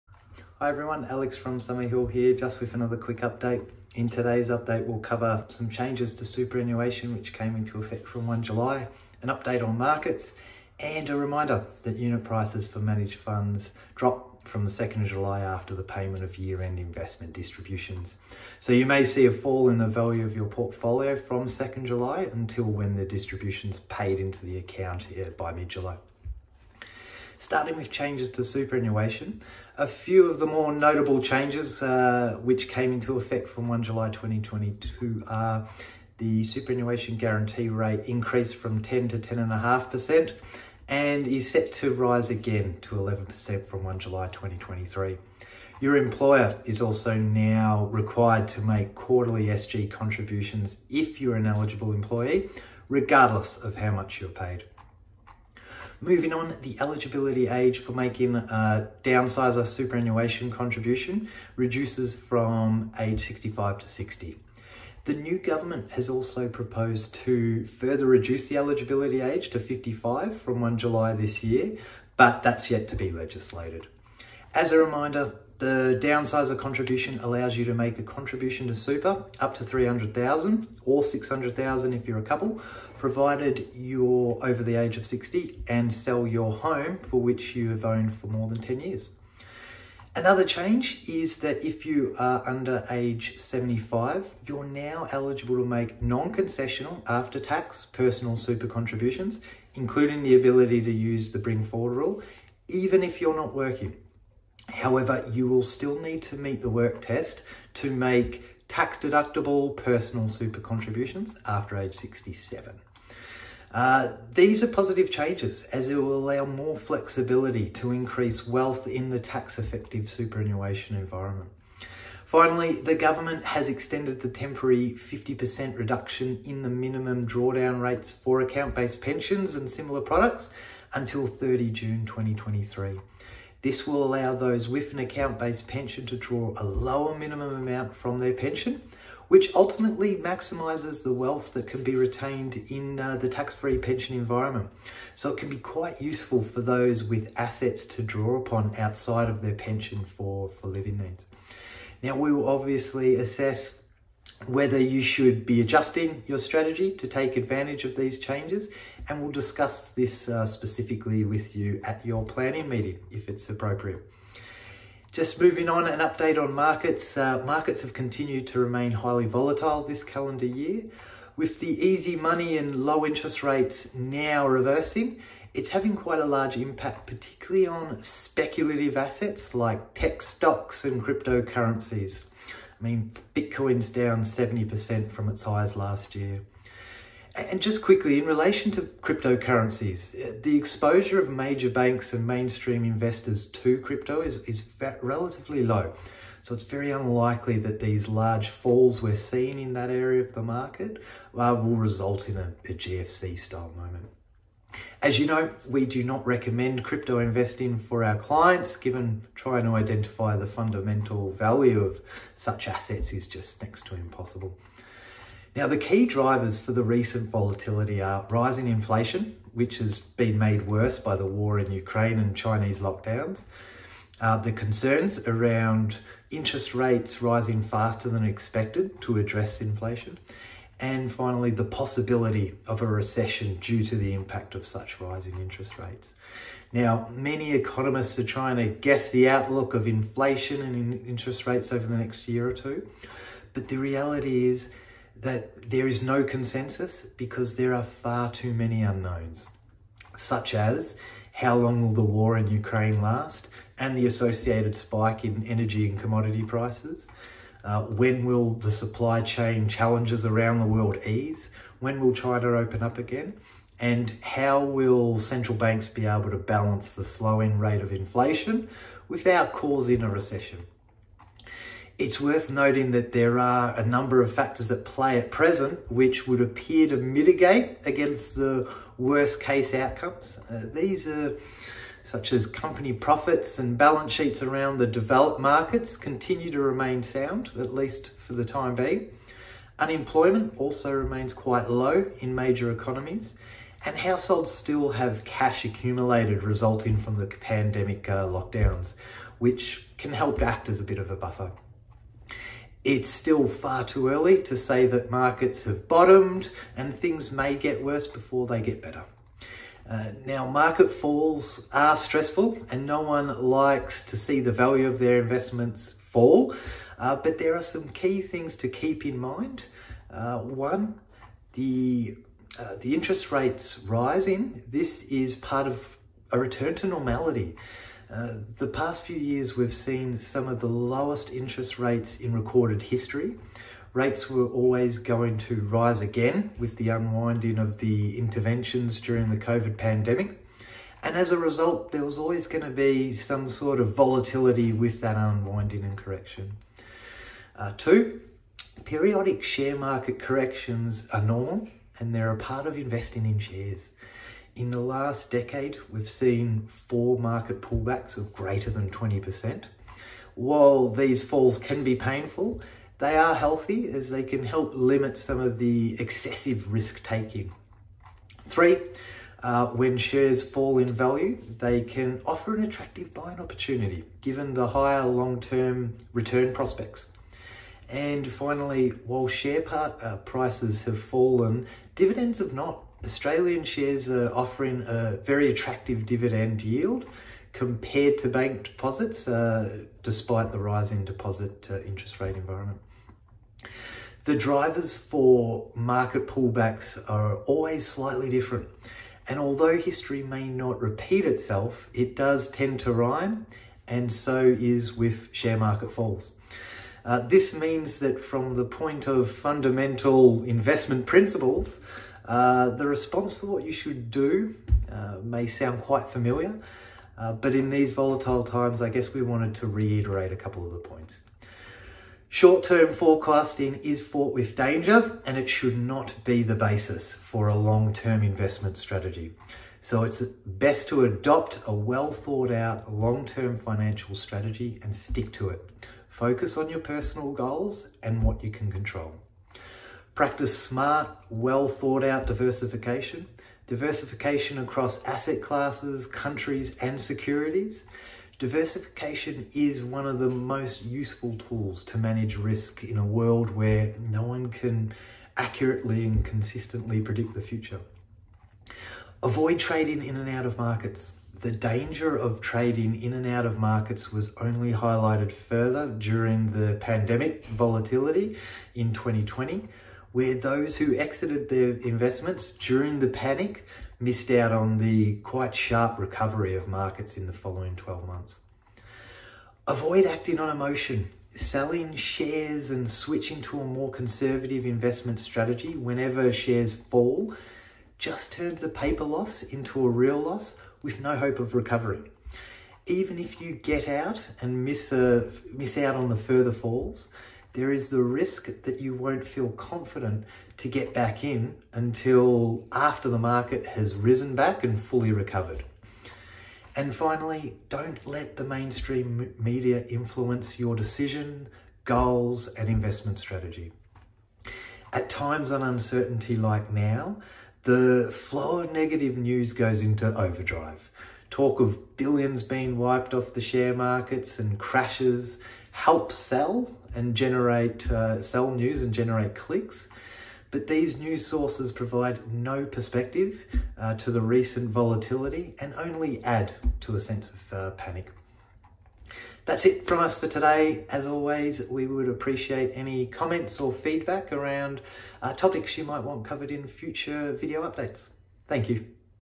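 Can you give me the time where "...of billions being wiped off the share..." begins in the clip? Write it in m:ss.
8:41.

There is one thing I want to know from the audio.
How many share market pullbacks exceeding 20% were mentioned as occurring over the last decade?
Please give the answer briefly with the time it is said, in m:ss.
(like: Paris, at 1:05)
4, at 5:56.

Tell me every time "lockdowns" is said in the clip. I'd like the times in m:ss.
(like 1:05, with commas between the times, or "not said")
3:42, 4:58.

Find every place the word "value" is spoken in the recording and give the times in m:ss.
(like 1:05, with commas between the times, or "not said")
0:19, 3:31, 5:14, 6:10.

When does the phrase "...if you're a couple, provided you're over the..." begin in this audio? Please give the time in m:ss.
1:21.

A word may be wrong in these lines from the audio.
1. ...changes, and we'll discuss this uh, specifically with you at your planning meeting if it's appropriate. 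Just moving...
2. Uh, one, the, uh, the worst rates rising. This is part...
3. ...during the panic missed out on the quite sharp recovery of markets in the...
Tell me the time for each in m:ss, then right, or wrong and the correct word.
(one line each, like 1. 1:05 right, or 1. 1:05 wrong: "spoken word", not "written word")
1. 2:38 right
2. 5:20 wrong: "interest", not "worst"
3. 7:52 right.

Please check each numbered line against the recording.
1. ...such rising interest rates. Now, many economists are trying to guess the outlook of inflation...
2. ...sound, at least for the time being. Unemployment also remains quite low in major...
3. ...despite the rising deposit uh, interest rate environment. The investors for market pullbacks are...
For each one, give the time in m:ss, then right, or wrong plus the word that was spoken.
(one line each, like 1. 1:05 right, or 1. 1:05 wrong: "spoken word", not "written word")
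1. 3:54 right
2. 4:47 right
3. 6:30 wrong: "drivers", not "investors".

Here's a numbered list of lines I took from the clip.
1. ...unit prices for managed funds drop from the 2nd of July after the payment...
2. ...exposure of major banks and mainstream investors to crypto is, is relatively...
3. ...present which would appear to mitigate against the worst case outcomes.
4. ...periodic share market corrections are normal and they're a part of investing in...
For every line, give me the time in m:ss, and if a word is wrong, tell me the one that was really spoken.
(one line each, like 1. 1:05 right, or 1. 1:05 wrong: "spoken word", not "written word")
1. 0:11 right
2. 3:10 right
3. 4:35 right
4. 5:48 right.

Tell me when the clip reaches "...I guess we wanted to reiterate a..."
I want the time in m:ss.
6:58.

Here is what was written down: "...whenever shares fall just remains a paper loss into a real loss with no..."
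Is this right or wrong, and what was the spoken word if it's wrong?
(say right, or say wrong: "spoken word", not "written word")
wrong: "turns", not "remains".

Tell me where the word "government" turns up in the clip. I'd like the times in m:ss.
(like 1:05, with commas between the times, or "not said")
1:05, 2:02.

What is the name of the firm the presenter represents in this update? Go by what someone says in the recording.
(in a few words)
Summerhill.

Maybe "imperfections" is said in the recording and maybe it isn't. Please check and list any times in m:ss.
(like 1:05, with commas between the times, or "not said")
not said.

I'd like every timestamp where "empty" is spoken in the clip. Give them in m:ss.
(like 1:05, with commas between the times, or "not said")
not said.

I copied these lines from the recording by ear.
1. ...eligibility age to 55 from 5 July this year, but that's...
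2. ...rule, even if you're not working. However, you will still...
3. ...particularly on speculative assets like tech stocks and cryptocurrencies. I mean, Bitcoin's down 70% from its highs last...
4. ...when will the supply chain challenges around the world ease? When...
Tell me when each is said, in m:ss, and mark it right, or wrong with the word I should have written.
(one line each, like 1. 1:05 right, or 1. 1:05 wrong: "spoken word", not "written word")
1. 1:08 wrong: "1", not "5"
2. 1:41 right
3. 2:57 right
4. 4:17 right.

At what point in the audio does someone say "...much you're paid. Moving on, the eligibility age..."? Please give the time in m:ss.
0:53.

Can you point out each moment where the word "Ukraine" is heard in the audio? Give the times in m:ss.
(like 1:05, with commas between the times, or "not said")
3:41, 4:12.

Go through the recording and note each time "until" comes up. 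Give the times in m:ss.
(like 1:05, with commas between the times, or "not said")
0:22, 2:10, 8:21.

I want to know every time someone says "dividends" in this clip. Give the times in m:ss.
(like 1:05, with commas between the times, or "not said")
6:21, 6:26.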